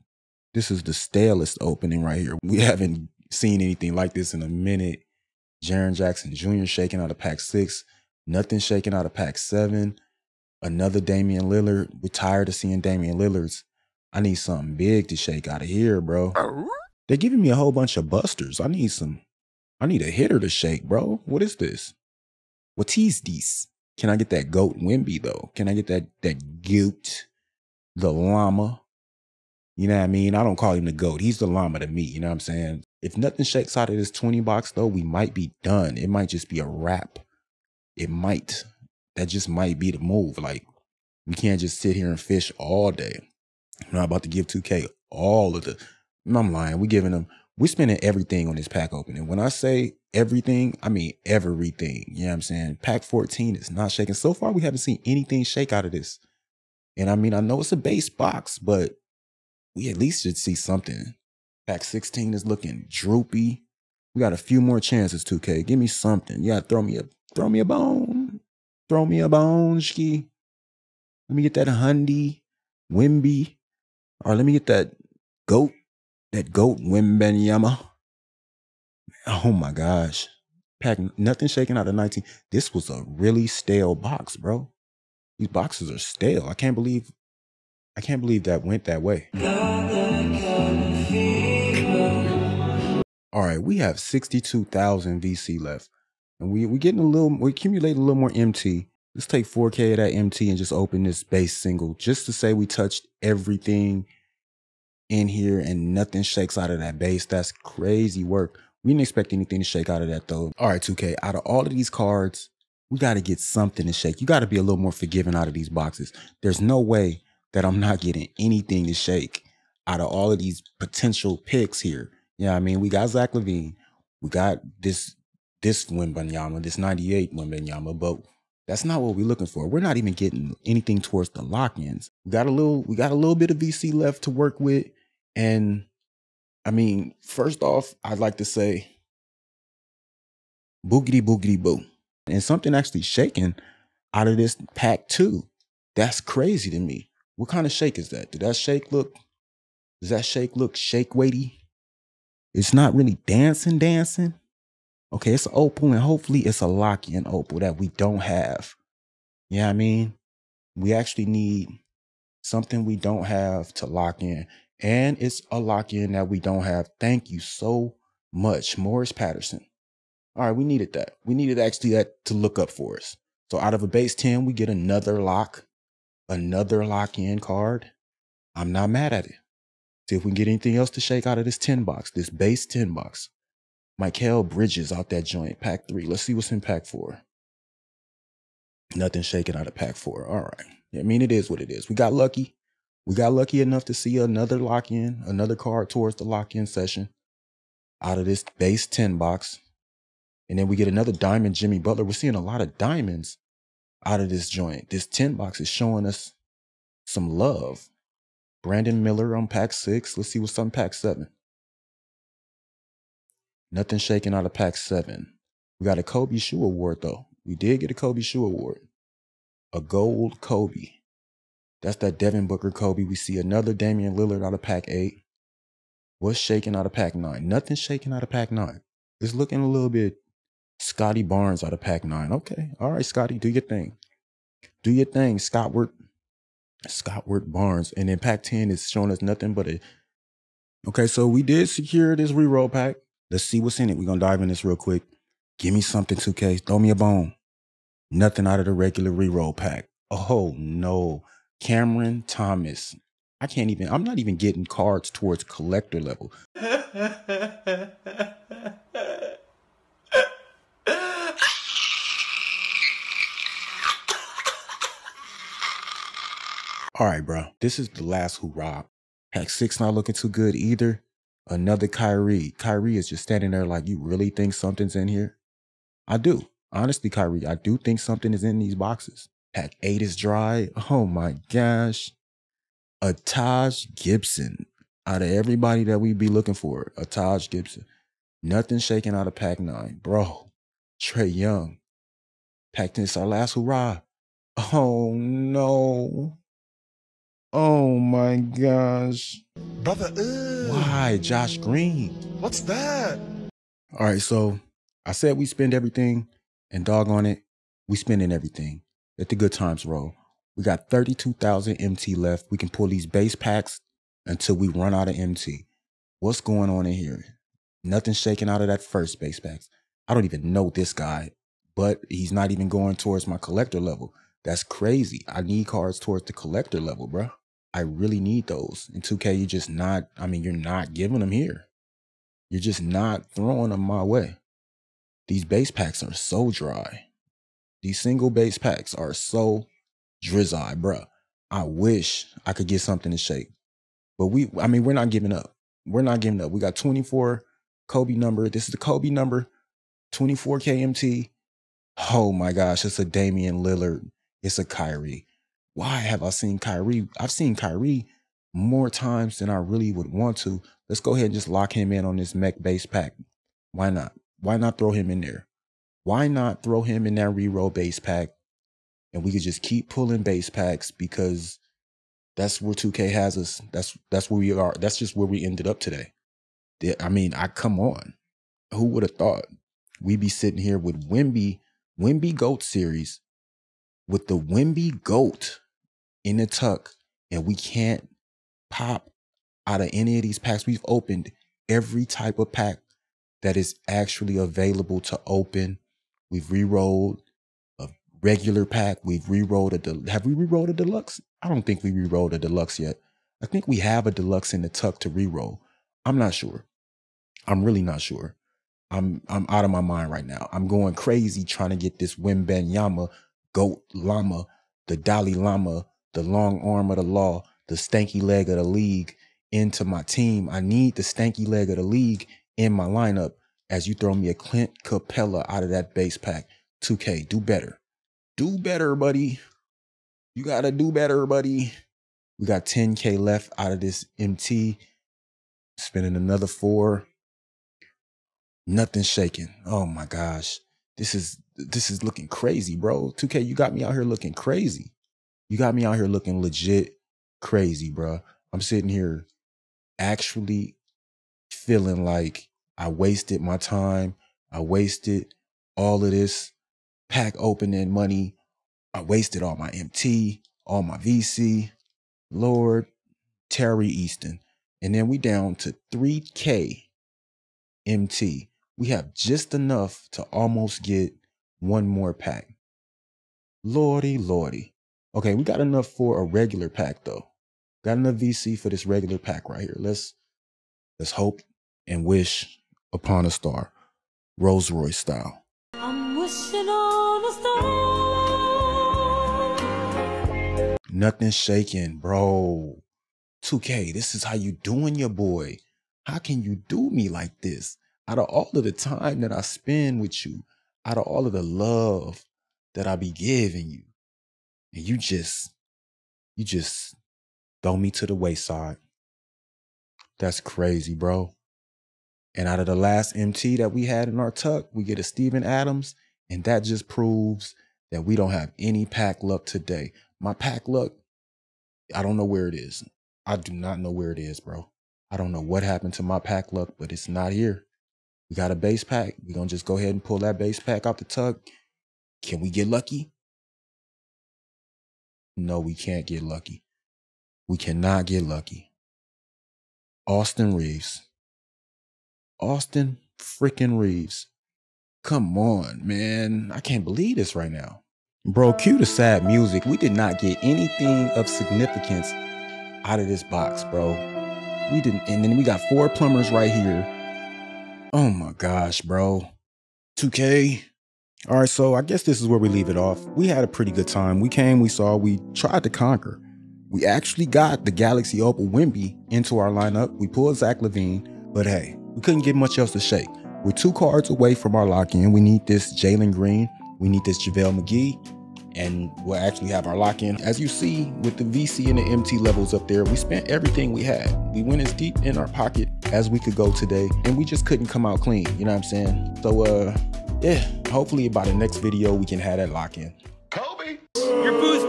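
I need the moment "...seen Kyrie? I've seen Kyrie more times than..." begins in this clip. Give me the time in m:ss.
5:56.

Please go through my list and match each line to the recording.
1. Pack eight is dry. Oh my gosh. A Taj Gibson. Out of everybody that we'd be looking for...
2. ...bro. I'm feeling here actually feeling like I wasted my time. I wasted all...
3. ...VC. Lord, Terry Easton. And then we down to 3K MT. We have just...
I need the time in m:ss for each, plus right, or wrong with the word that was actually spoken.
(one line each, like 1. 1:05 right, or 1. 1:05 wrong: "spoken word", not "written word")
1. 4:39 right
2. 7:27 wrong: "sitting", not "feeling"
3. 7:40 right.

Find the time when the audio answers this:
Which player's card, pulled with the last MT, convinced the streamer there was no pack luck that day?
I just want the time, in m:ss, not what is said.
8:35.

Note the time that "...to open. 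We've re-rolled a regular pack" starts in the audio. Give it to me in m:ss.
6:35.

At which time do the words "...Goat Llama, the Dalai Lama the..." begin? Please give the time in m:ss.
6:53.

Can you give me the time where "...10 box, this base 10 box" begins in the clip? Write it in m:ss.
3:01.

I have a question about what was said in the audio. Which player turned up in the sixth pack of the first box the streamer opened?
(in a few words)
Jaren Jackson Jr.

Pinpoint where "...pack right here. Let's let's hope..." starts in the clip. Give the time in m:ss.
7:59.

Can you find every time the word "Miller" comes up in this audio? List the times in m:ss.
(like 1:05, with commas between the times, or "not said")
3:29.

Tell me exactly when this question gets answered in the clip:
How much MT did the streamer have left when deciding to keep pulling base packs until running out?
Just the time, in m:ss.
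5:10.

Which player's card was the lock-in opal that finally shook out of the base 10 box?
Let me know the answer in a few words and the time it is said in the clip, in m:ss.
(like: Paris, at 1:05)
Morris Patterson, at 2:48.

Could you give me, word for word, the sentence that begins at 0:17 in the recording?
They're giving me a whole bunch of busters.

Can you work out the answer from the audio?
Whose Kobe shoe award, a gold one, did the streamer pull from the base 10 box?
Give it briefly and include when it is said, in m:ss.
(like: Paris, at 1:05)
Devin Booker, at 3:42.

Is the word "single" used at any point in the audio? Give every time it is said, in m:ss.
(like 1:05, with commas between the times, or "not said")
1:41, 5:38.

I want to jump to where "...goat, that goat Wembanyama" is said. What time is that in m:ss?
1:15.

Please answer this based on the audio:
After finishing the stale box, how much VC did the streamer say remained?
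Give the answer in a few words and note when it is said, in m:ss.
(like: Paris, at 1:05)
62,000, at 1:34.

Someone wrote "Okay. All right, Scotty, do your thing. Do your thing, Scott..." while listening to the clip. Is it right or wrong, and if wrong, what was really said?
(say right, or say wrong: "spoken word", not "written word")
right.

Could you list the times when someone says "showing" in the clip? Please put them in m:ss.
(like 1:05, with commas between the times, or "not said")
3:25, 3:58.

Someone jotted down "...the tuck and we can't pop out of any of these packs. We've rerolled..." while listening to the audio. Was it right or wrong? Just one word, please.
wrong.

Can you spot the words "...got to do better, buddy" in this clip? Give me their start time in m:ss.
7:10.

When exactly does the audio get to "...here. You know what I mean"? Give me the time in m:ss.
2:01.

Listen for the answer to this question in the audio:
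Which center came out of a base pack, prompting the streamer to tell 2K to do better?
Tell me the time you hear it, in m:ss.
7:04.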